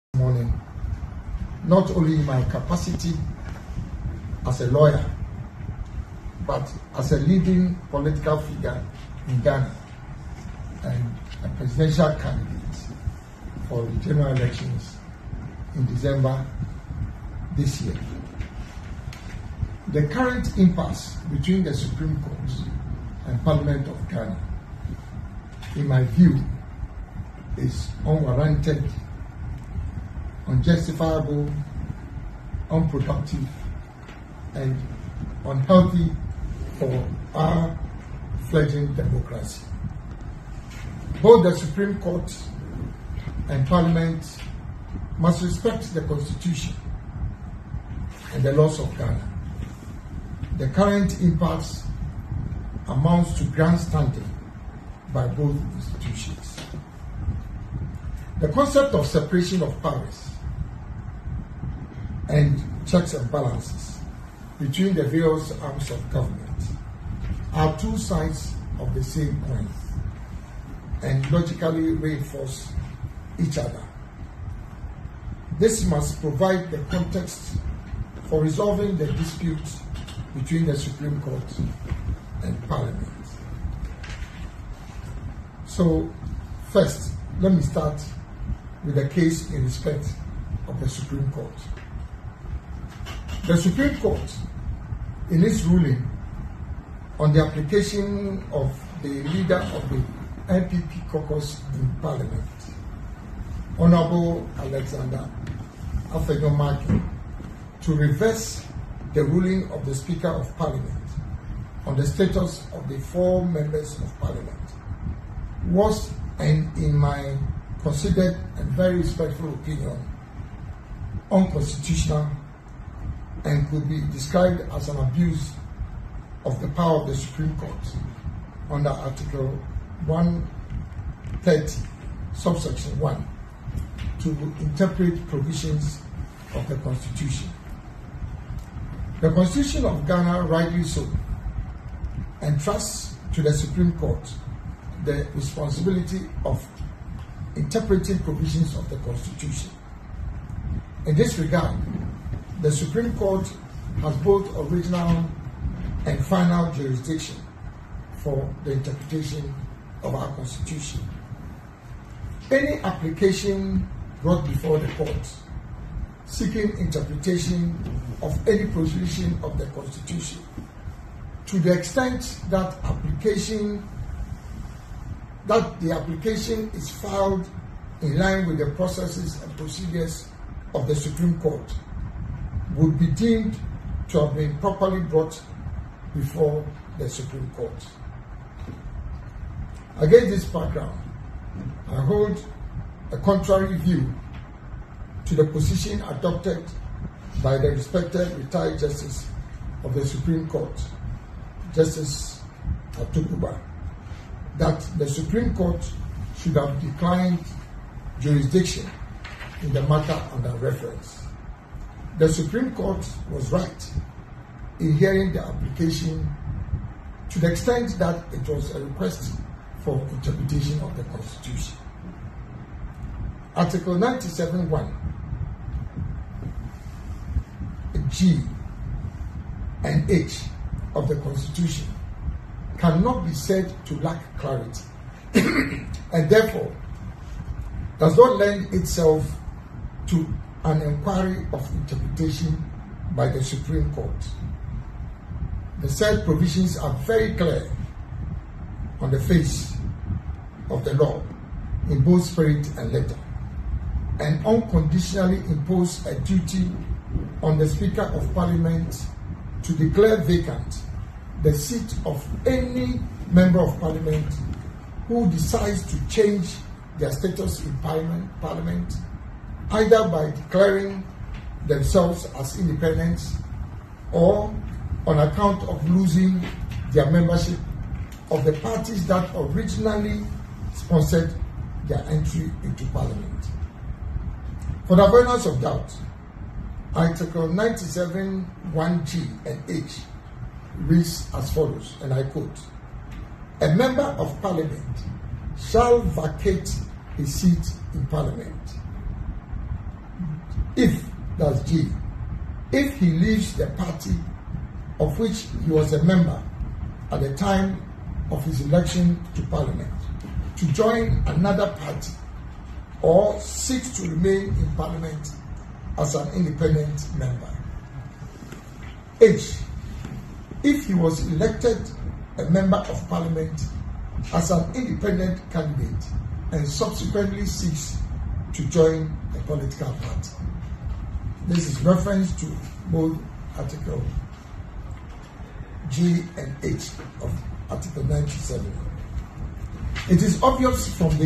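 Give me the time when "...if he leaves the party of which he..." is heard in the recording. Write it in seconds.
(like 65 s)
302 s.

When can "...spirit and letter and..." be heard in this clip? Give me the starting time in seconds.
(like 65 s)
252 s.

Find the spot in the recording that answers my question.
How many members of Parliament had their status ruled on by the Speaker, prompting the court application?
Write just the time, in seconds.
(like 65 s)
112 s.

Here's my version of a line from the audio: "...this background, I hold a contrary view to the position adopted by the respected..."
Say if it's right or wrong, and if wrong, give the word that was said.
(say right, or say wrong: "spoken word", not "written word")
right.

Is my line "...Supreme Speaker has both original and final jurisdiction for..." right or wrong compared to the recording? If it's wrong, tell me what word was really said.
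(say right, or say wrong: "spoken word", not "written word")
wrong: "Court", not "Speaker".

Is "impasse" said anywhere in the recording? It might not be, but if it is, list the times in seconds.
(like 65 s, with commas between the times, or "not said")
20 s, 51 s.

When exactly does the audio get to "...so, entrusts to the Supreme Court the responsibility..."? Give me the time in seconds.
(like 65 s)
140 s.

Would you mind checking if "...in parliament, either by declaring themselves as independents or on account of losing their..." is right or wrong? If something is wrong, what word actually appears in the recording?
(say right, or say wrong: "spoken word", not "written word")
right.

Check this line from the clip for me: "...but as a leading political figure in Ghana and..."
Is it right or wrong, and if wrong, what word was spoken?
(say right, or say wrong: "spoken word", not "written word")
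right.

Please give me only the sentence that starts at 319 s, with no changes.
H if he was elected a member of parliament as an independent candidate and subsequently seeks to join a political party.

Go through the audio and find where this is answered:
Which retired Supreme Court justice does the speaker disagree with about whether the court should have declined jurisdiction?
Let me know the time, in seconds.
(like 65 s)
201 s.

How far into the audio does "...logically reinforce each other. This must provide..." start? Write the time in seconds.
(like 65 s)
71 s.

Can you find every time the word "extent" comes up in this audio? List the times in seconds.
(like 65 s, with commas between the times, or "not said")
171 s, 217 s.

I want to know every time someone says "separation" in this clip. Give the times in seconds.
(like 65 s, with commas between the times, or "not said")
59 s.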